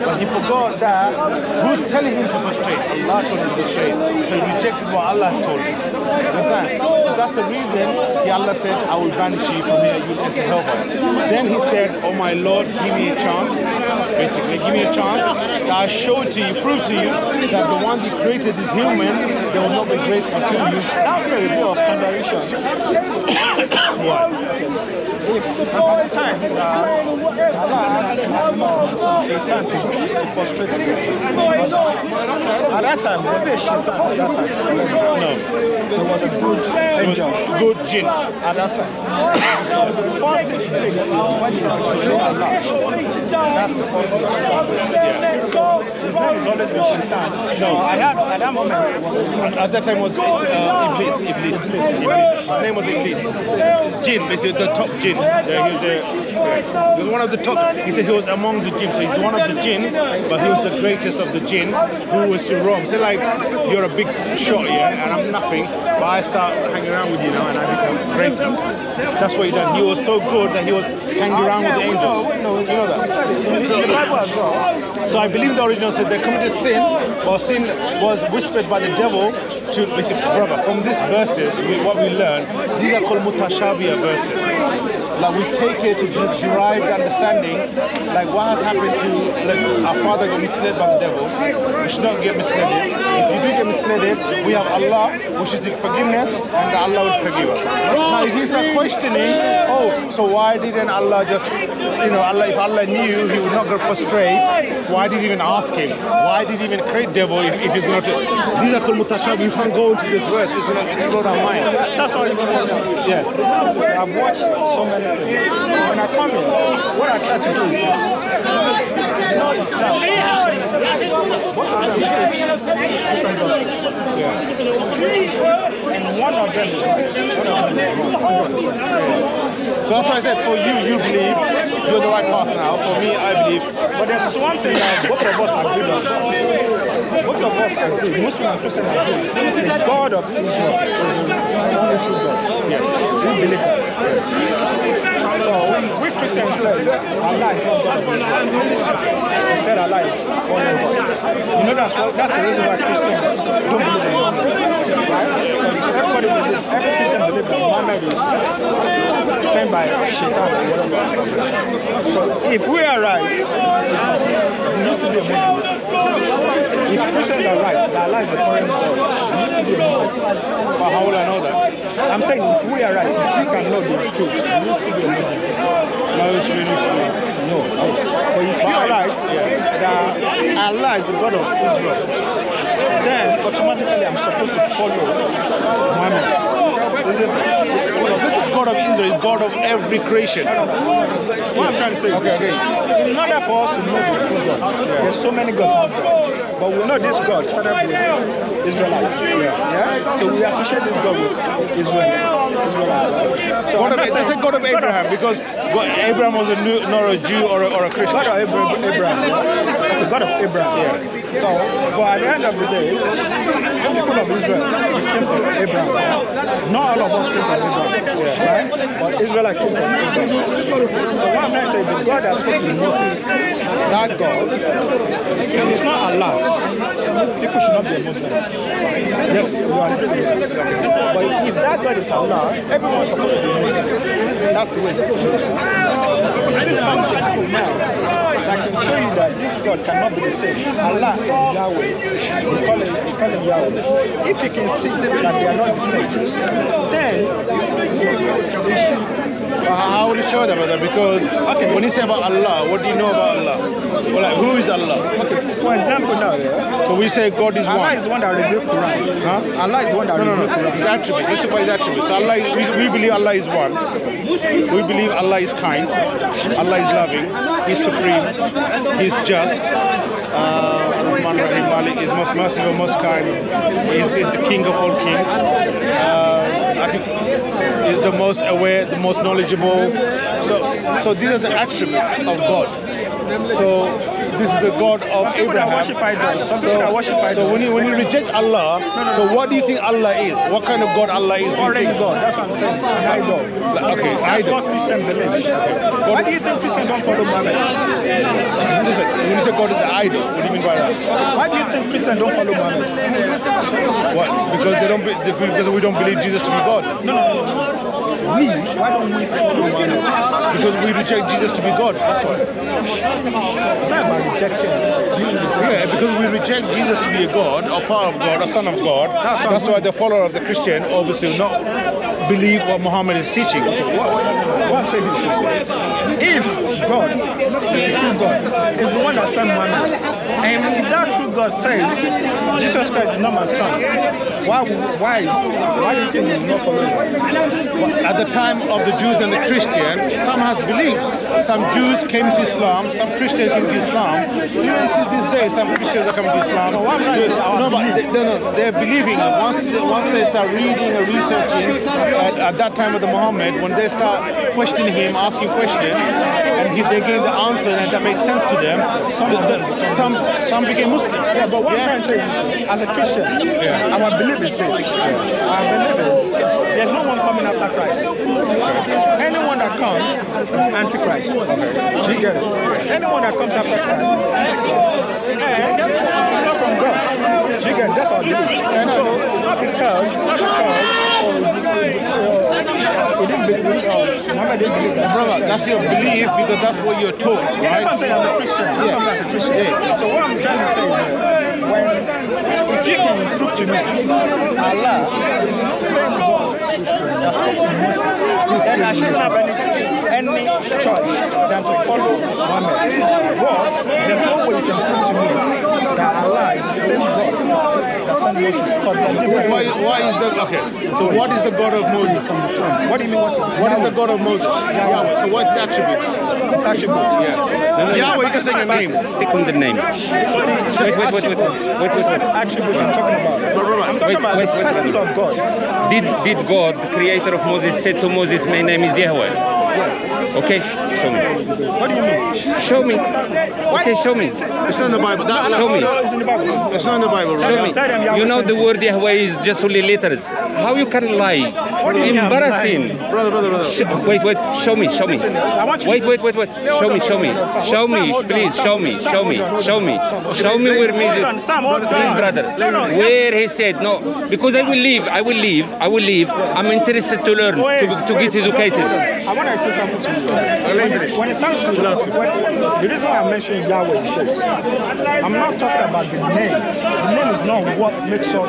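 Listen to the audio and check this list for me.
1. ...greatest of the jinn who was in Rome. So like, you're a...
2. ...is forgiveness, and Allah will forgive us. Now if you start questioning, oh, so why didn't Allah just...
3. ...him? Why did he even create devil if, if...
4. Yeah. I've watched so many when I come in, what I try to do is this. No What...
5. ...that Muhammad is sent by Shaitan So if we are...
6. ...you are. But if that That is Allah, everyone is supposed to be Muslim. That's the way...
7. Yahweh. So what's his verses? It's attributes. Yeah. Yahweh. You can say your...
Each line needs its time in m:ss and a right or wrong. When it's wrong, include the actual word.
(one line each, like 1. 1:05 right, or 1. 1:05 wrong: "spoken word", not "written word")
1. 1:00 right
2. 1:35 right
3. 1:45 right
4. 1:53 right
5. 2:37 right
6. 3:49 wrong: "God", not "That"
7. 6:54 wrong: "attributes", not "verses".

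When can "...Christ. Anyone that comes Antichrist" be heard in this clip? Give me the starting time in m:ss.
6:07.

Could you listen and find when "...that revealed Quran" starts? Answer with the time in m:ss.
4:18.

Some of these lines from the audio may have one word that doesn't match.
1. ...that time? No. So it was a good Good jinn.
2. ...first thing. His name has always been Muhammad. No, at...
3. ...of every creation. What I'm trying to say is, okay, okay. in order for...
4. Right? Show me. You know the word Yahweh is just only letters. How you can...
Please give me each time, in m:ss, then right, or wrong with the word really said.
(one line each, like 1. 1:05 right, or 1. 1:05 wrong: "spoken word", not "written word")
1. 0:33 right
2. 0:43 wrong: "Shaitan", not "Muhammad"
3. 3:09 right
4. 7:17 right.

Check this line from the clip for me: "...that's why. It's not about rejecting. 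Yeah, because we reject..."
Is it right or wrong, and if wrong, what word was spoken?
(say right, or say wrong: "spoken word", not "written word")
right.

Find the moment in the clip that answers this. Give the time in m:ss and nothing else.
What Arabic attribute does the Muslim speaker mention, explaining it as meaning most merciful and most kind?
4:31.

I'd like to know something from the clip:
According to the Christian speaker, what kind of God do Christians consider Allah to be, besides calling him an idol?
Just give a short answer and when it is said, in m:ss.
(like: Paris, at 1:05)
Orange God, at 4:51.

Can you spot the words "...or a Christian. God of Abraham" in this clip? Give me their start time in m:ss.
3:27.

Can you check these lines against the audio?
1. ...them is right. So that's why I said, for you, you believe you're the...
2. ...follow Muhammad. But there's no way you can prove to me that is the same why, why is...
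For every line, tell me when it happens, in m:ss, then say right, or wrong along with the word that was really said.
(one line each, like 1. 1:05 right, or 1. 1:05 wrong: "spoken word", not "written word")
1. 2:06 right
2. 6:41 right.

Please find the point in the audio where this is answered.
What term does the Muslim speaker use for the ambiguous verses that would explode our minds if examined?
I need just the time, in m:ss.
1:23.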